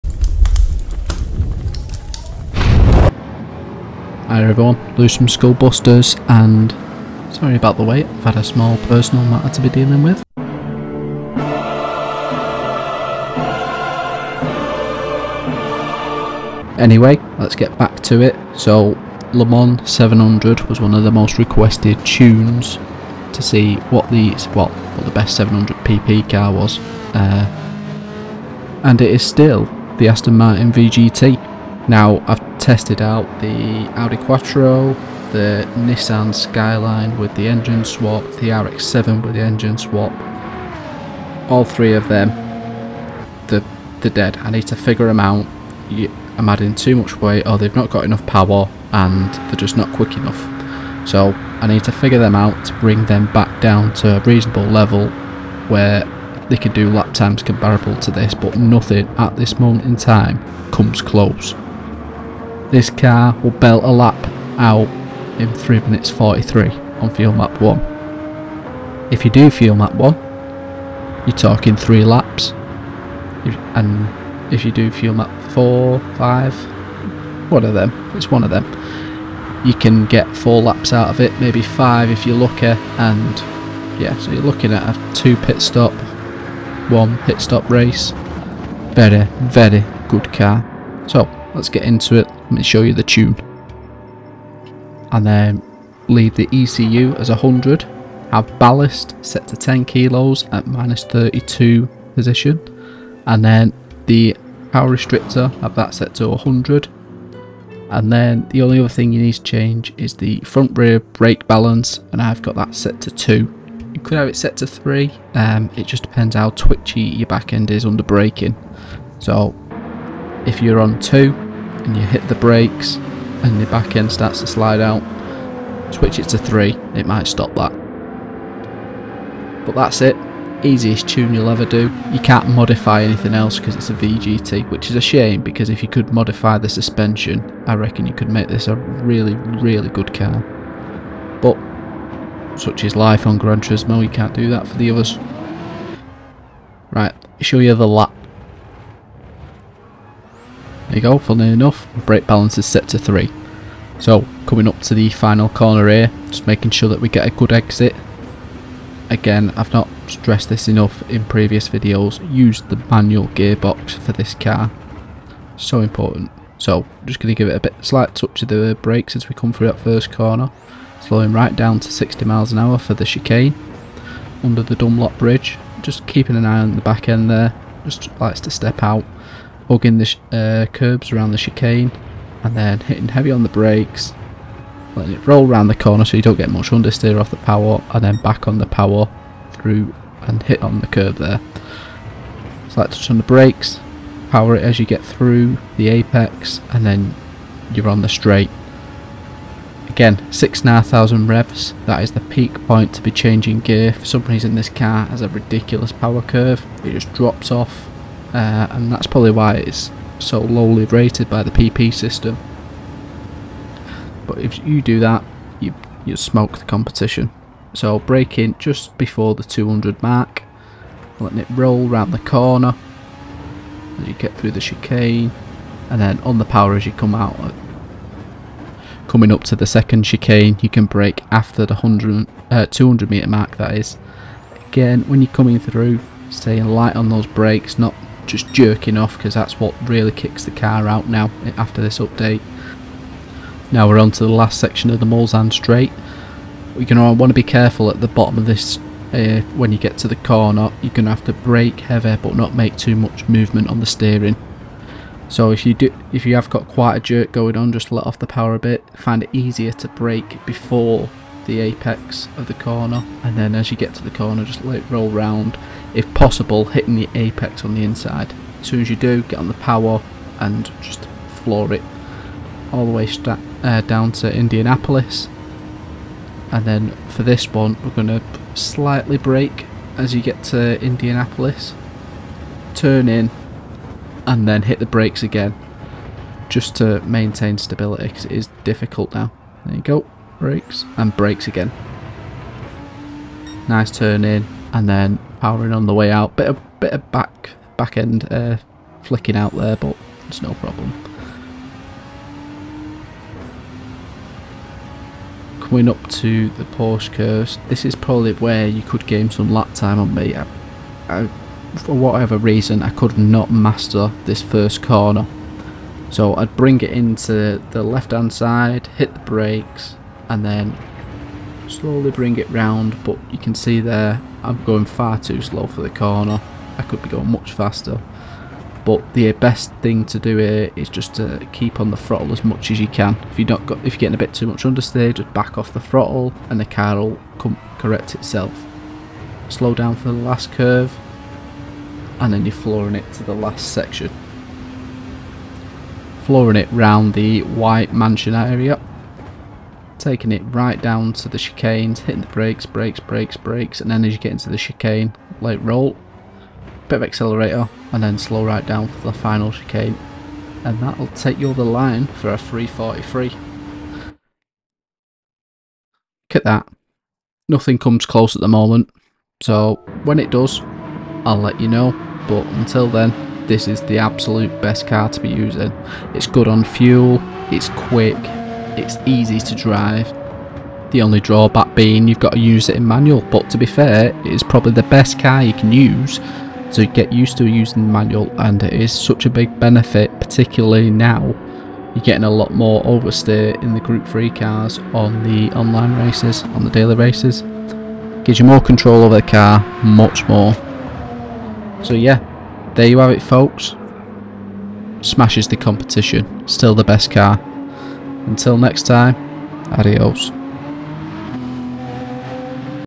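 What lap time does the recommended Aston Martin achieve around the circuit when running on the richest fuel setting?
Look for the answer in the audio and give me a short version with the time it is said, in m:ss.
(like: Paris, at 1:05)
3 minutes 43, at 1:05.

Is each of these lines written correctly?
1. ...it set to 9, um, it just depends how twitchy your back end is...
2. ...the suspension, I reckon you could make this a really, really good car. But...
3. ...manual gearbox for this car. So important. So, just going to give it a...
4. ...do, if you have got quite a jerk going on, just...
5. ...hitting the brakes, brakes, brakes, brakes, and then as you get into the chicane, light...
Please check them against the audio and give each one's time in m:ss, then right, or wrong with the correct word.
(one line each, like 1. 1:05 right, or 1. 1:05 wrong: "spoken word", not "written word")
1. 1:54 wrong: "3", not "9"
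2. 2:16 right
3. 2:42 right
4. 4:15 right
5. 5:51 right.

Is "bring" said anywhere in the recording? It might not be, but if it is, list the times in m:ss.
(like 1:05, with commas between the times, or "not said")
0:52, 5:16, 5:22.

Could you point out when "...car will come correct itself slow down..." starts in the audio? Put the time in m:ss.
5:36.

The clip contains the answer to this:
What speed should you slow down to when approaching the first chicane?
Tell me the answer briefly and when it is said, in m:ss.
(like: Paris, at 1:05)
60 mph, at 2:51.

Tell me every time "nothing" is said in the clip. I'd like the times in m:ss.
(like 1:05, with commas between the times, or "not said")
0:58, 6:07.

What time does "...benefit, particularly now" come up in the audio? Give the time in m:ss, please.
6:29.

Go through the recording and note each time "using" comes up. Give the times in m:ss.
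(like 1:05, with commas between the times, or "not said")
6:15, 6:27.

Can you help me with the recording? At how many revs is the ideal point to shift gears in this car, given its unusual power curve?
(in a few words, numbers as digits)
6,500.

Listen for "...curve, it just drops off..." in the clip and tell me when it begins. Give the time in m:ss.
3:26.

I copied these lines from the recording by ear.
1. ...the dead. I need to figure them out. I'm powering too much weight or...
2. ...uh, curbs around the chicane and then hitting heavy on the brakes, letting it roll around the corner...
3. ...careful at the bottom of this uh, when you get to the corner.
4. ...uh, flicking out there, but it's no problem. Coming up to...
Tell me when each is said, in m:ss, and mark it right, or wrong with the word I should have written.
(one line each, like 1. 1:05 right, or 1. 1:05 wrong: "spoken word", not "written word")
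1. 0:44 wrong: "adding", not "powering"
2. 3:00 right
3. 4:07 right
4. 4:58 right.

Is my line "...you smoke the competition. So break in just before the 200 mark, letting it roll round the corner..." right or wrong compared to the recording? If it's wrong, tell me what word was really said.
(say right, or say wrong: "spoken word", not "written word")
right.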